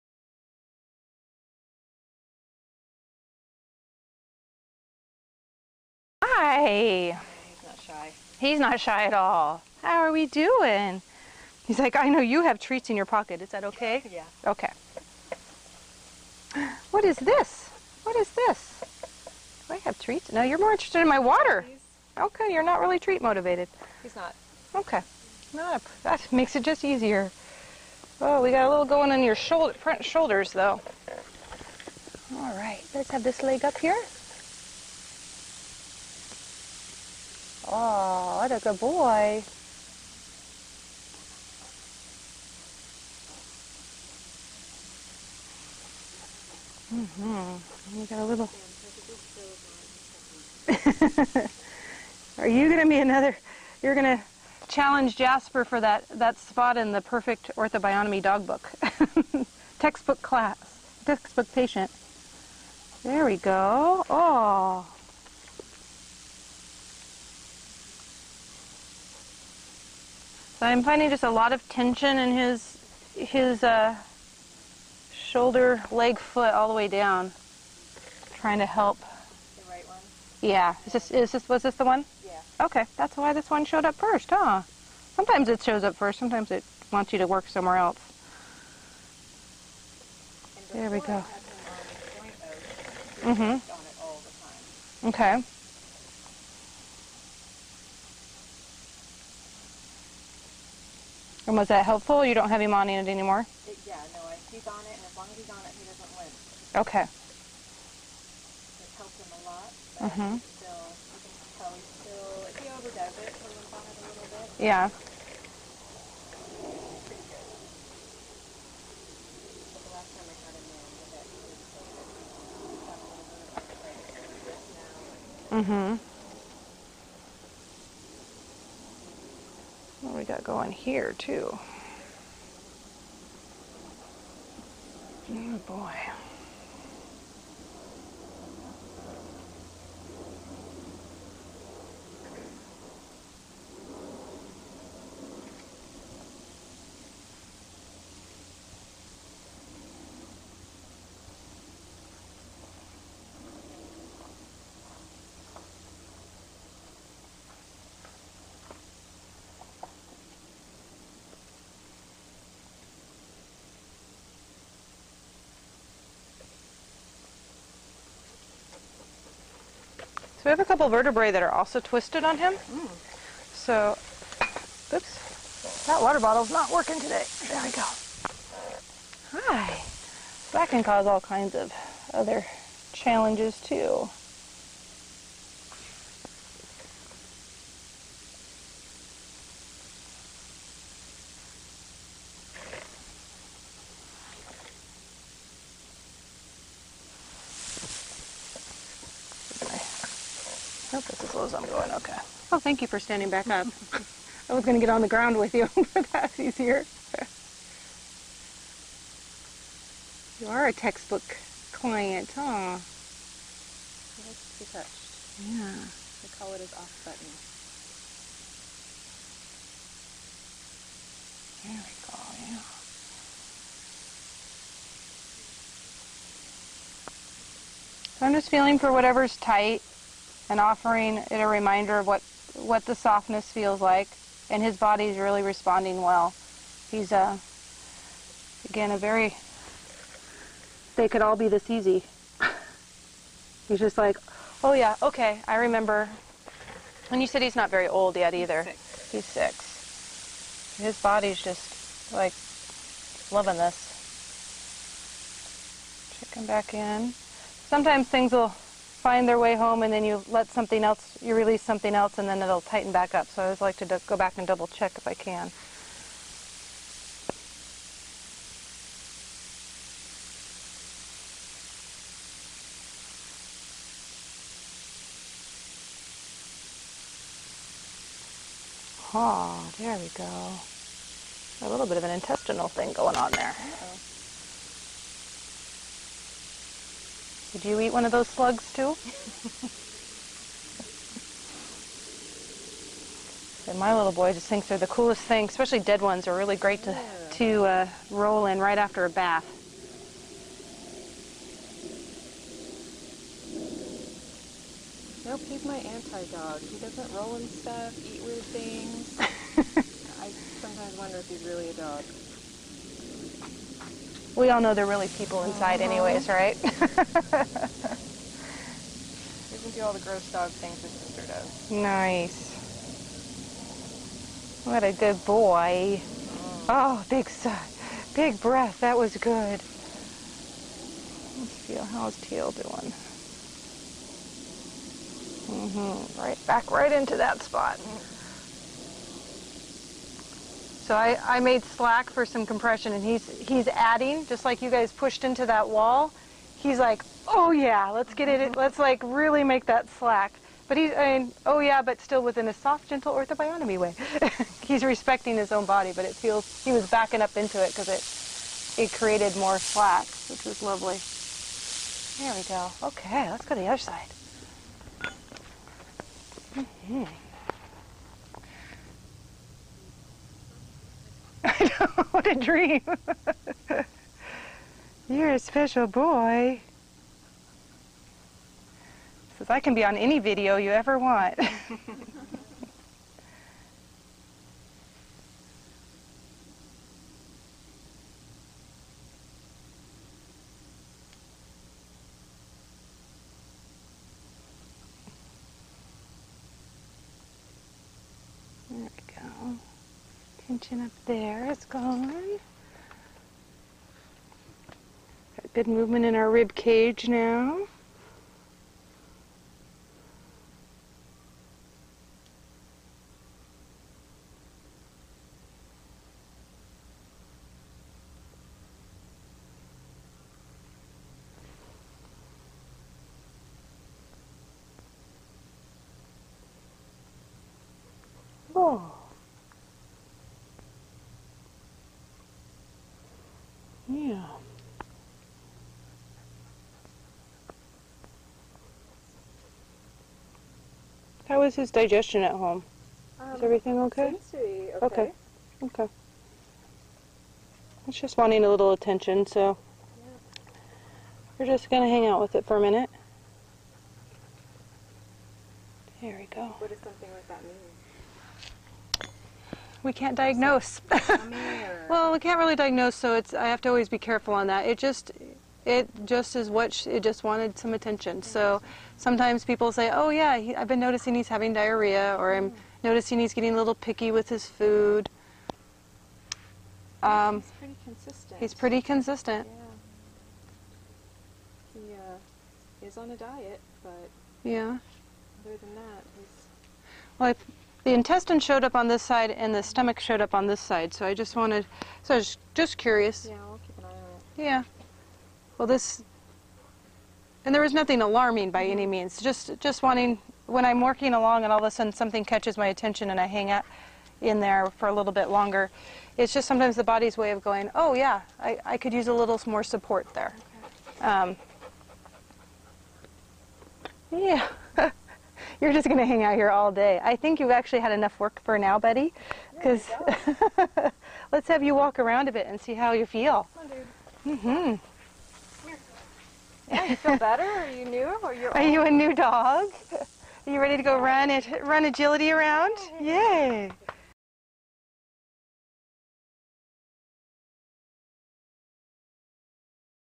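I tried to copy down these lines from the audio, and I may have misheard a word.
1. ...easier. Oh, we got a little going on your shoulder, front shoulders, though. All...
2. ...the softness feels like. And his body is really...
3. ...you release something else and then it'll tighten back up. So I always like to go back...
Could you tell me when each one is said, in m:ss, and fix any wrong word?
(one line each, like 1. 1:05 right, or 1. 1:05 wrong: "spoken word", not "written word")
1. 0:26 right
2. 3:52 right
3. 4:21 right.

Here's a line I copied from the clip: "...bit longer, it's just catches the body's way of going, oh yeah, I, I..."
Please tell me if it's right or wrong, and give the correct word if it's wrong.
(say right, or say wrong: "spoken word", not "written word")
wrong: "sometimes", not "catches".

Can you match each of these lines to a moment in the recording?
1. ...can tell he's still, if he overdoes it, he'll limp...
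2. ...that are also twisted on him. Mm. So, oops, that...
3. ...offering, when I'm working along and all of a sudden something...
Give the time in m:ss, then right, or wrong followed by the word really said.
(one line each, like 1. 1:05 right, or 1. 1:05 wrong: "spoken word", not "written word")
1. 1:51 right
2. 2:51 right
3. 8:19 wrong: "wanting", not "offering".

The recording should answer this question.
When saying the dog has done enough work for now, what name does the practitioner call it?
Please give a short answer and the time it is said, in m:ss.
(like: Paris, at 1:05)
Betty, at 8:38.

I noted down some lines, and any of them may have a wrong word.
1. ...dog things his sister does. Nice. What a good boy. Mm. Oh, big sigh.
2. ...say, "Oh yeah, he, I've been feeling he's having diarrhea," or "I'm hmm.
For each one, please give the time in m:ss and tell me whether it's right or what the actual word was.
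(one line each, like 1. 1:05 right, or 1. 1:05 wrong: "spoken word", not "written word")
1. 5:20 right
2. 7:49 wrong: "noticing", not "feeling".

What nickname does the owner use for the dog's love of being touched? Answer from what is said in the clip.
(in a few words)
Off button.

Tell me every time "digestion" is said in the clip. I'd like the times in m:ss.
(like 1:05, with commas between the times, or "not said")
7:21.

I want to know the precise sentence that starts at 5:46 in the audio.
He's like, oh yeah, let's get it, let's like really make that slack.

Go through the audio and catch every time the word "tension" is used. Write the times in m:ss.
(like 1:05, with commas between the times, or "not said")
1:11, 6:40.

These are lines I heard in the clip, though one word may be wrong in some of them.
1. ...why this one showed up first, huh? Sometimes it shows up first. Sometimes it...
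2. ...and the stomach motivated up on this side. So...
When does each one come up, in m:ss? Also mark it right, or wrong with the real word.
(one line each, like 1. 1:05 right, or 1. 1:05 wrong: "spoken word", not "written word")
1. 1:23 right
2. 8:09 wrong: "showed", not "motivated".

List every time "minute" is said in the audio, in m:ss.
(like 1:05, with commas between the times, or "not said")
7:32.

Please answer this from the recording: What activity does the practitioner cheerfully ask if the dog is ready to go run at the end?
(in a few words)
Agility.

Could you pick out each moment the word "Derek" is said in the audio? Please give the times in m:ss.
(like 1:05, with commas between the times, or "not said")
not said.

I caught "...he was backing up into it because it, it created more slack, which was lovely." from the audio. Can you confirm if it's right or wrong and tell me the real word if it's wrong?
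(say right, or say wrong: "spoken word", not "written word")
right.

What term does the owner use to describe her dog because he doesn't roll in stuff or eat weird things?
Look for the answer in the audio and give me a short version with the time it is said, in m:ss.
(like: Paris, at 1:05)
Anti-dog, at 5:05.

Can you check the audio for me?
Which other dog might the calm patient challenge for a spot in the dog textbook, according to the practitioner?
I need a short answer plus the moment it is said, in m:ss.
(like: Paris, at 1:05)
Jasper, at 0:55.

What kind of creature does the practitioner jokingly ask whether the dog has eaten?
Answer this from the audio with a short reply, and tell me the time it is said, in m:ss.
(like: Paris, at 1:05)
Slugs, at 4:48.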